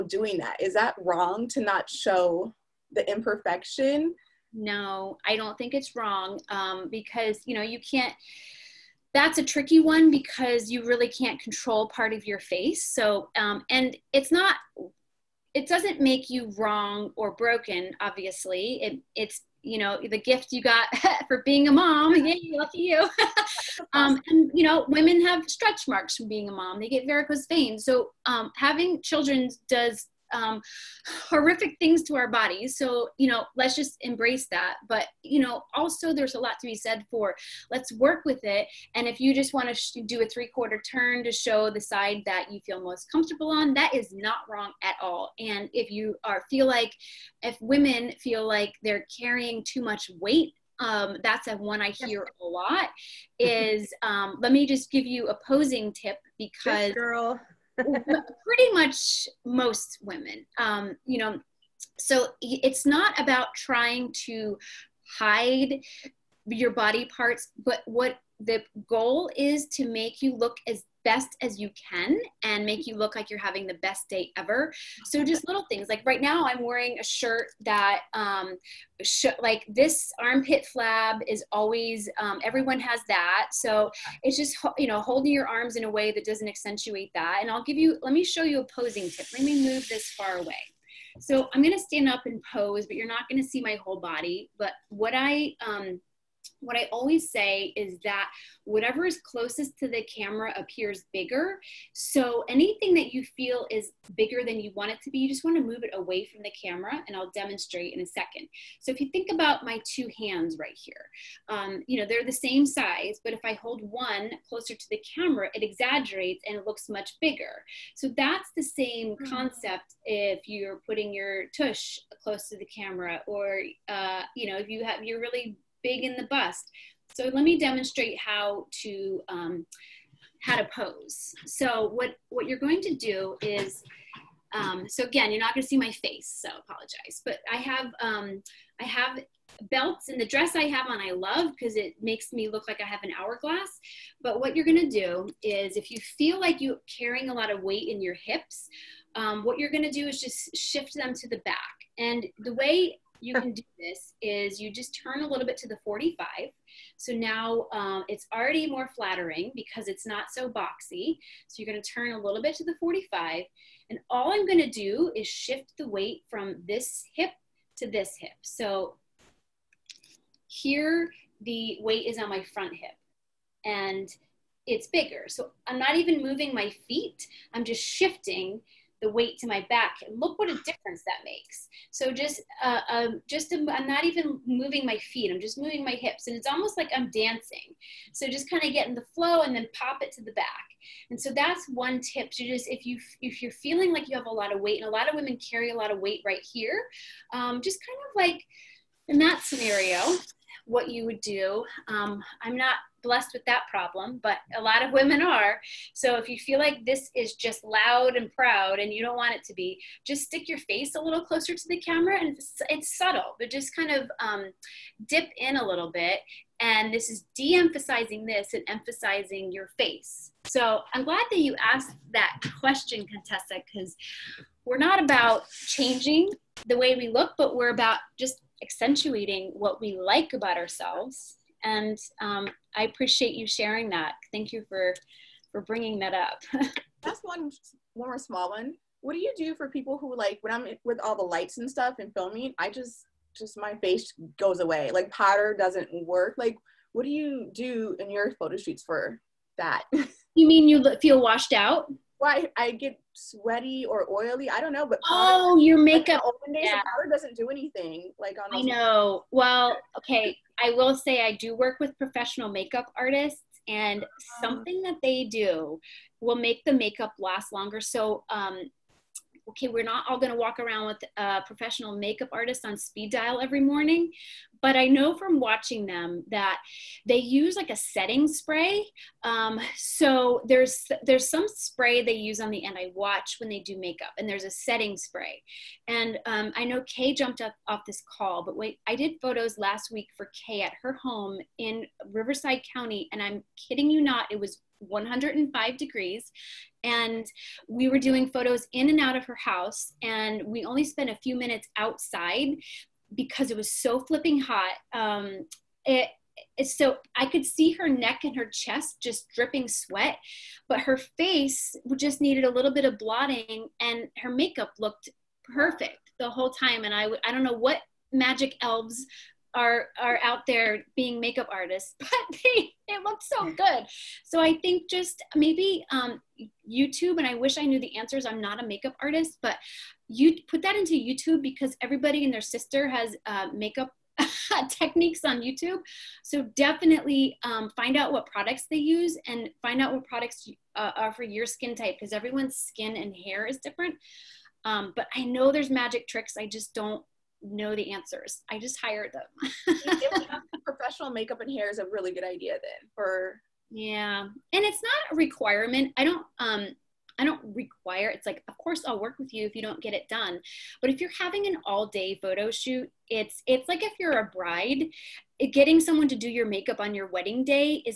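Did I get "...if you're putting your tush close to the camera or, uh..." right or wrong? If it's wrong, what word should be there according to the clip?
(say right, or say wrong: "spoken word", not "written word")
right.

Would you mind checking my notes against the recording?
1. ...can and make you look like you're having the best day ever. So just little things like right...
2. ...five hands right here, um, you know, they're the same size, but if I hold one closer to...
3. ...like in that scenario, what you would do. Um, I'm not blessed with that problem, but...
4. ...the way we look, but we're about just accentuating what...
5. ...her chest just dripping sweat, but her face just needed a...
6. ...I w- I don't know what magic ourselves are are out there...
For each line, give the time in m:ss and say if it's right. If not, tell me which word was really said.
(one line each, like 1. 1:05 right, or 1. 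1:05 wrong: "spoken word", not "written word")
1. 1:11 right
2. 1:49 wrong: "two", not "five"
3. 3:18 right
4. 3:46 right
5. 5:08 right
6. 5:16 wrong: "elves", not "ourselves".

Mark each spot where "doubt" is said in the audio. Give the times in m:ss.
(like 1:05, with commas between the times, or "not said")
not said.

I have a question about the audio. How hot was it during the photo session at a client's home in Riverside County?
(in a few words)
105 degrees.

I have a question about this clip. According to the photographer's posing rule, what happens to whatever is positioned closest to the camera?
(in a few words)
Appears bigger.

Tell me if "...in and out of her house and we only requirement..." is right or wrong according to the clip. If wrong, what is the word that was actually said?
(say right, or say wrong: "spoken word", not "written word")
wrong: "spent", not "requirement".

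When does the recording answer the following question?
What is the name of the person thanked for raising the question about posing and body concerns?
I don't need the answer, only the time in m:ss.
3:43.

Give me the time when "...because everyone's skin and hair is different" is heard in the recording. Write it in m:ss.
5:41.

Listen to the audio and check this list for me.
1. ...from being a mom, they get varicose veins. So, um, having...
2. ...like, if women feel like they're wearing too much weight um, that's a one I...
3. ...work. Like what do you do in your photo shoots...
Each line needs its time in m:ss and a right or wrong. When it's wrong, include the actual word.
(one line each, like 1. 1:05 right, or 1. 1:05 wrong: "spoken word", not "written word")
1. 0:26 right
2. 0:46 wrong: "carrying", not "wearing"
3. 4:06 right.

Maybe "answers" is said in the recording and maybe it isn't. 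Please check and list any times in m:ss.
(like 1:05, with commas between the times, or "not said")
5:27, 5:47.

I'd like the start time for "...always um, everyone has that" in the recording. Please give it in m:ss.
1:21.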